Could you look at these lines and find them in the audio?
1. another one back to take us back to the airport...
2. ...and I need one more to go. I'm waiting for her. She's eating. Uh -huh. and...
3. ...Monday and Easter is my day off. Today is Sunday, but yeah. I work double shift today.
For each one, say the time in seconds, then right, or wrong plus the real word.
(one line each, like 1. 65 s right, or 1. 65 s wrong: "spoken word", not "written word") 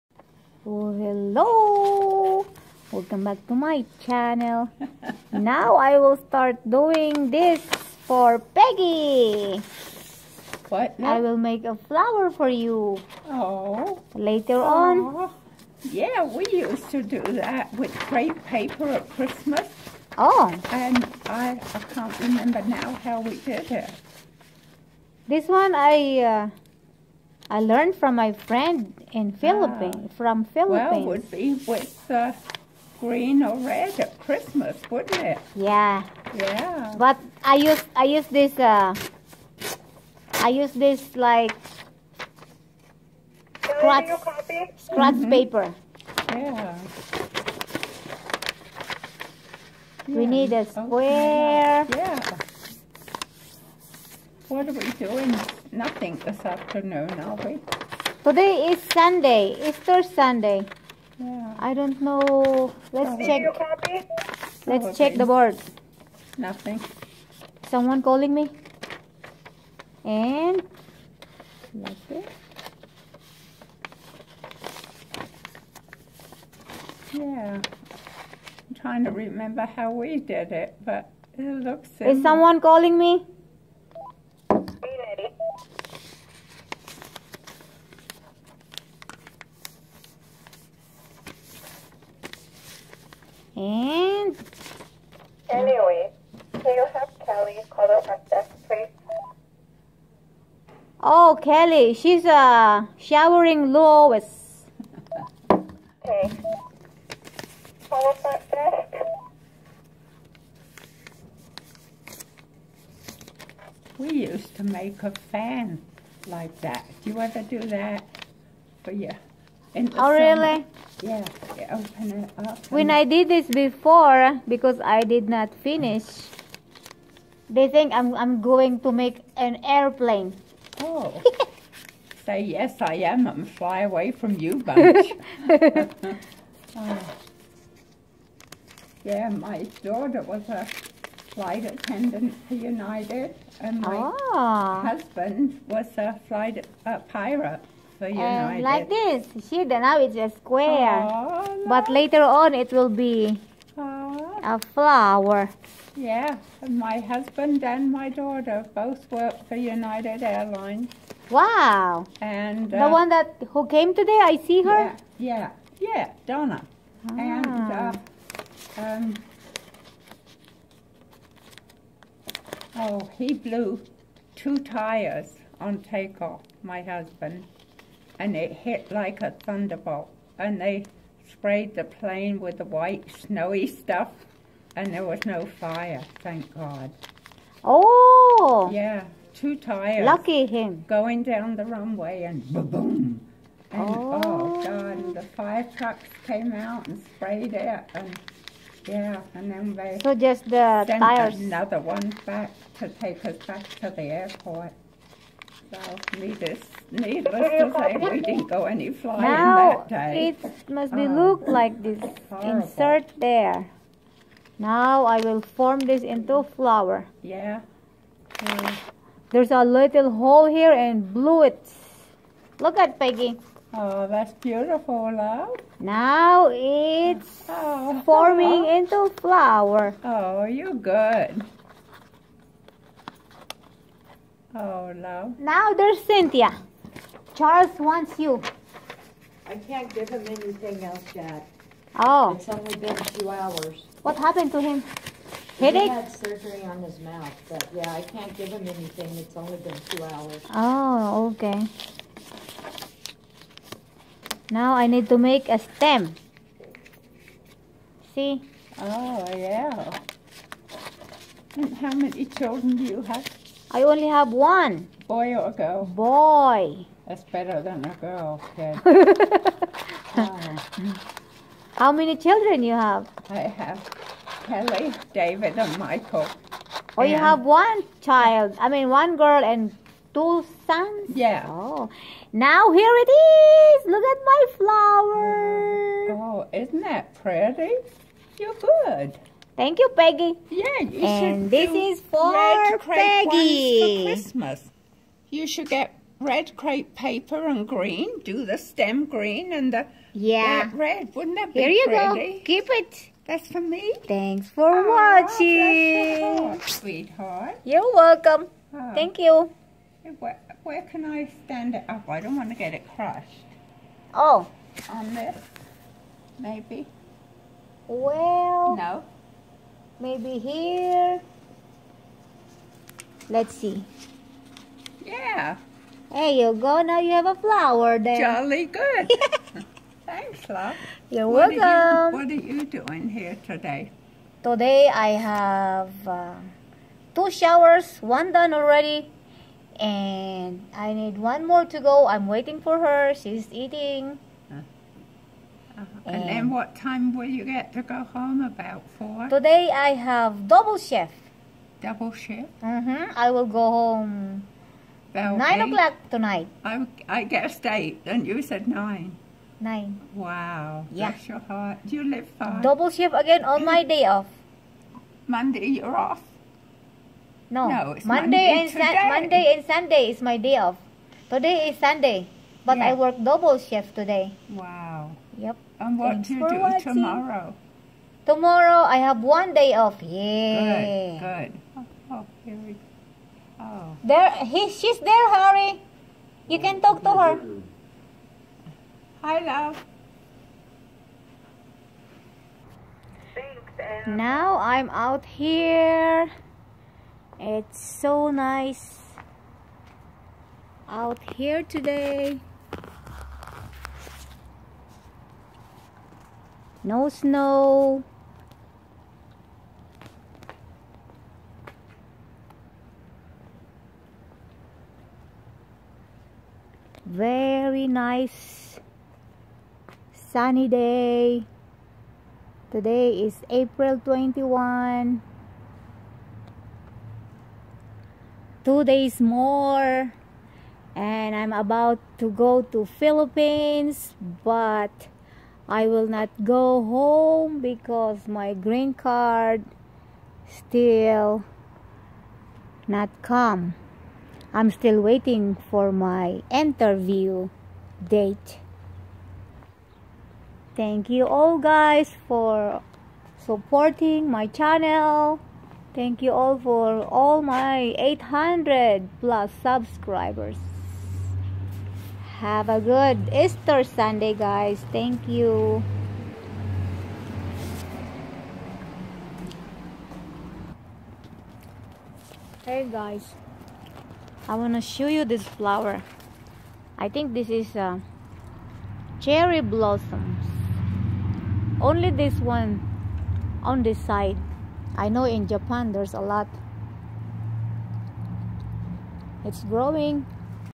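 1. 201 s right
2. 339 s right
3. 369 s wrong: "Sunday", not "Easter".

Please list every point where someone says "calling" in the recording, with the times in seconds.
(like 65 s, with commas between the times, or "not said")
68 s, 82 s.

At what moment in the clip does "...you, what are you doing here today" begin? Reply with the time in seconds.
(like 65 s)
332 s.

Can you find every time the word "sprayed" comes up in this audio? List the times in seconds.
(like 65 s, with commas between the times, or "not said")
181 s, 197 s.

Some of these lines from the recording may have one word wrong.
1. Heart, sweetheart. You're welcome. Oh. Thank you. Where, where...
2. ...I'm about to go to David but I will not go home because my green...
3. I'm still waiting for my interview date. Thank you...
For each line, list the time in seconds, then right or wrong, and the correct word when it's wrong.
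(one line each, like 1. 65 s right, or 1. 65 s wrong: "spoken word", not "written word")
1. 306 s right
2. 431 s wrong: "Philippines", not "David"
3. 444 s right.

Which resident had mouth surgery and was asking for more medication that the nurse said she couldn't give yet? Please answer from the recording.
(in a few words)
Charles.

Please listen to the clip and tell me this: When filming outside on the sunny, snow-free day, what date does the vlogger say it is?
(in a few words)
April 21.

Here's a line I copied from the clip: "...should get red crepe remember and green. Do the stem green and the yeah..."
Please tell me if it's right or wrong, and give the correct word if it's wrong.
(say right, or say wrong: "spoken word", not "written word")
wrong: "paper", not "remember".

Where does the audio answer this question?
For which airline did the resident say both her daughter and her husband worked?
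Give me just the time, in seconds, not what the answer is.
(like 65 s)
159 s.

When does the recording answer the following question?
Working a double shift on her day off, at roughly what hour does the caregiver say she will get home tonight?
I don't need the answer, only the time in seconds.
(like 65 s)
355 s.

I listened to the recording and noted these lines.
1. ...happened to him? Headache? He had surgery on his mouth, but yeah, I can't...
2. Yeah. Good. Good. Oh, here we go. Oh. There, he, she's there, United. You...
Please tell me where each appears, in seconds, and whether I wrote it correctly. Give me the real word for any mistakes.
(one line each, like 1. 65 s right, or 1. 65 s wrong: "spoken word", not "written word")
1. 244 s right
2. 380 s wrong: "Harry", not "United".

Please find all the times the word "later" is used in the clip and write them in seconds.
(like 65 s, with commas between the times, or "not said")
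14 s, 151 s.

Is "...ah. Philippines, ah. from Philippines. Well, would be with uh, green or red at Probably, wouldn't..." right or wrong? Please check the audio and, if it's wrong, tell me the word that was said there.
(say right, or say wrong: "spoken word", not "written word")
wrong: "Christmas", not "Probably".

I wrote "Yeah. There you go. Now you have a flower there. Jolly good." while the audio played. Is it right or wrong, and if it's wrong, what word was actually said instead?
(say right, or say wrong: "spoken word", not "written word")
right.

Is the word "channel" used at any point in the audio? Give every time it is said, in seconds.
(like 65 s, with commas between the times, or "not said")
4 s, 454 s.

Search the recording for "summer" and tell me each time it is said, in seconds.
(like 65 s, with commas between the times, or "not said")
119 s.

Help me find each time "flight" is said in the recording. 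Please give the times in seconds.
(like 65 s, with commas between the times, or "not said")
141 s, 146 s.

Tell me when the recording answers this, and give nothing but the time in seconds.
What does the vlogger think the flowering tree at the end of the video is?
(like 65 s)
479 s.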